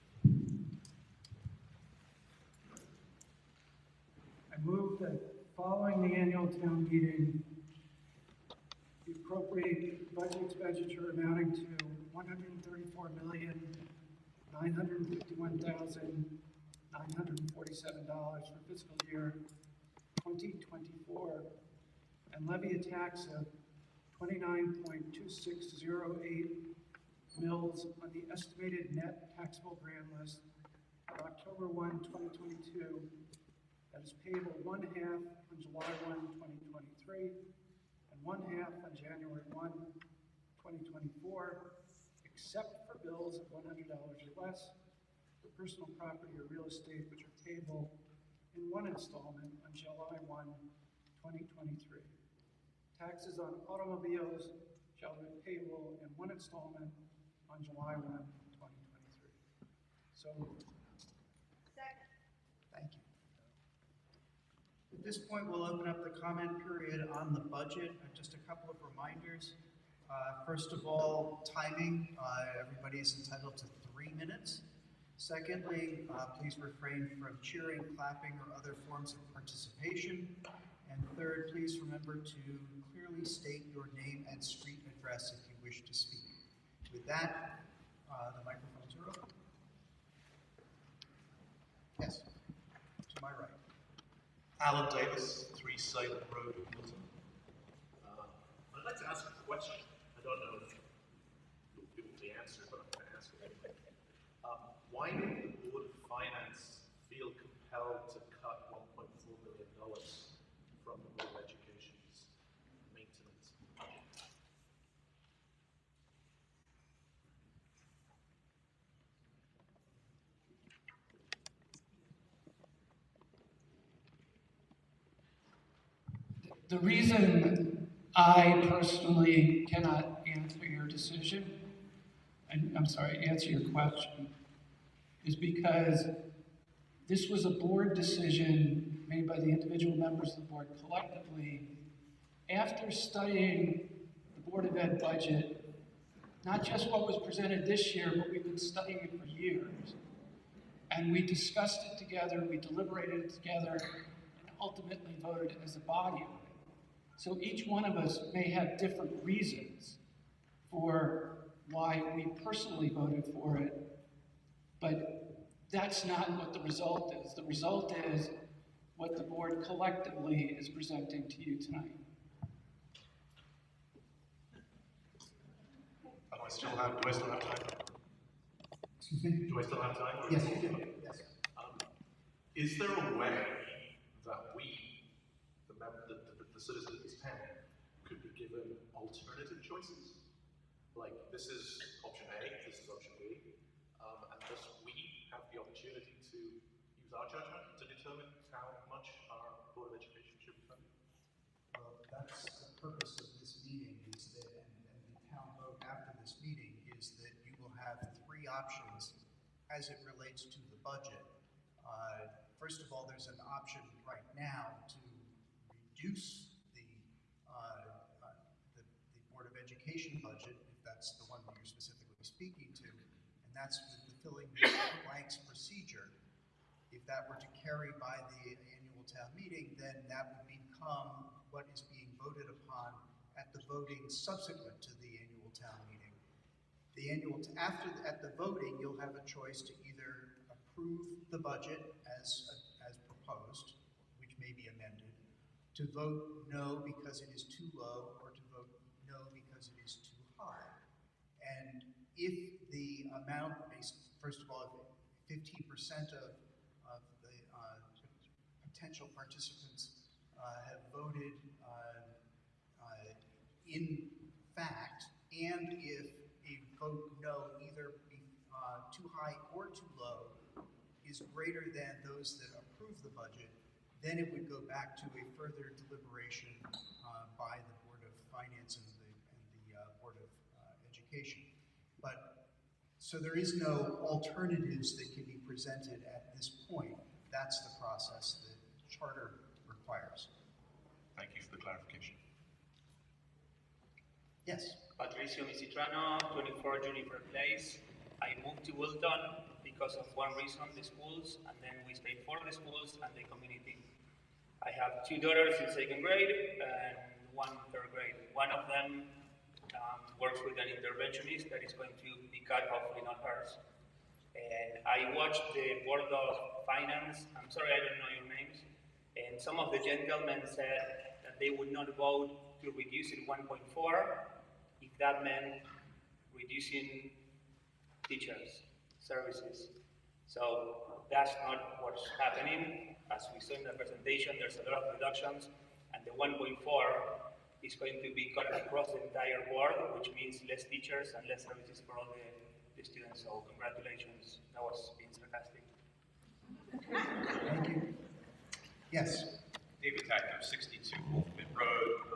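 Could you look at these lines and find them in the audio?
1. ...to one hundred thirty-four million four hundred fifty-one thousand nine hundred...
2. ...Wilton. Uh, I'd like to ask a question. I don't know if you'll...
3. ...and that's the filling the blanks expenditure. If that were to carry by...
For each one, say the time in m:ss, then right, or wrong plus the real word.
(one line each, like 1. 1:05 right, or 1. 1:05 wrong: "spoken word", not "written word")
1. 0:11 wrong: "nine", not "four"
2. 1:36 right
3. 3:42 wrong: "procedure", not "expenditure".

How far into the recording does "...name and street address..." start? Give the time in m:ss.
1:23.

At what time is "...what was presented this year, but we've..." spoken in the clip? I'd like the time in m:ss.
2:26.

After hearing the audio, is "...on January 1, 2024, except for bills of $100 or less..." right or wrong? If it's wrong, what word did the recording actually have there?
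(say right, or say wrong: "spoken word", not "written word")
right.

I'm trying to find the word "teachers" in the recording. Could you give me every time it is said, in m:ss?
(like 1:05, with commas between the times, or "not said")
5:28, 5:40.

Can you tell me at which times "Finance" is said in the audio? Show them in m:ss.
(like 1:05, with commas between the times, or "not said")
1:46, 4:38, 5:16.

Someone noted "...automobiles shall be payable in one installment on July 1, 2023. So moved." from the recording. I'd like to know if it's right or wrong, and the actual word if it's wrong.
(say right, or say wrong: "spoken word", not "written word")
right.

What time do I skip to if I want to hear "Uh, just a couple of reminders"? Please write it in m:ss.
1:08.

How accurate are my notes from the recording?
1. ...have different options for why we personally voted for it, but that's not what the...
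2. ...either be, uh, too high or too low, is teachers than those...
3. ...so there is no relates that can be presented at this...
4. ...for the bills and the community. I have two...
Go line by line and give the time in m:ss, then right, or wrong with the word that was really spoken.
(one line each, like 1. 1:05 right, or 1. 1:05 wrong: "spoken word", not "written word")
1. 2:38 wrong: "reasons", not "options"
2. 4:27 wrong: "greater", not "teachers"
3. 4:42 wrong: "alternatives", not "relates"
4. 5:02 wrong: "schools", not "bills".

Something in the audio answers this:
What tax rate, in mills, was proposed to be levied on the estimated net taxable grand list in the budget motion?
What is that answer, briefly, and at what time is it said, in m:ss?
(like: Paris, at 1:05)
29.2608 mills, at 0:24.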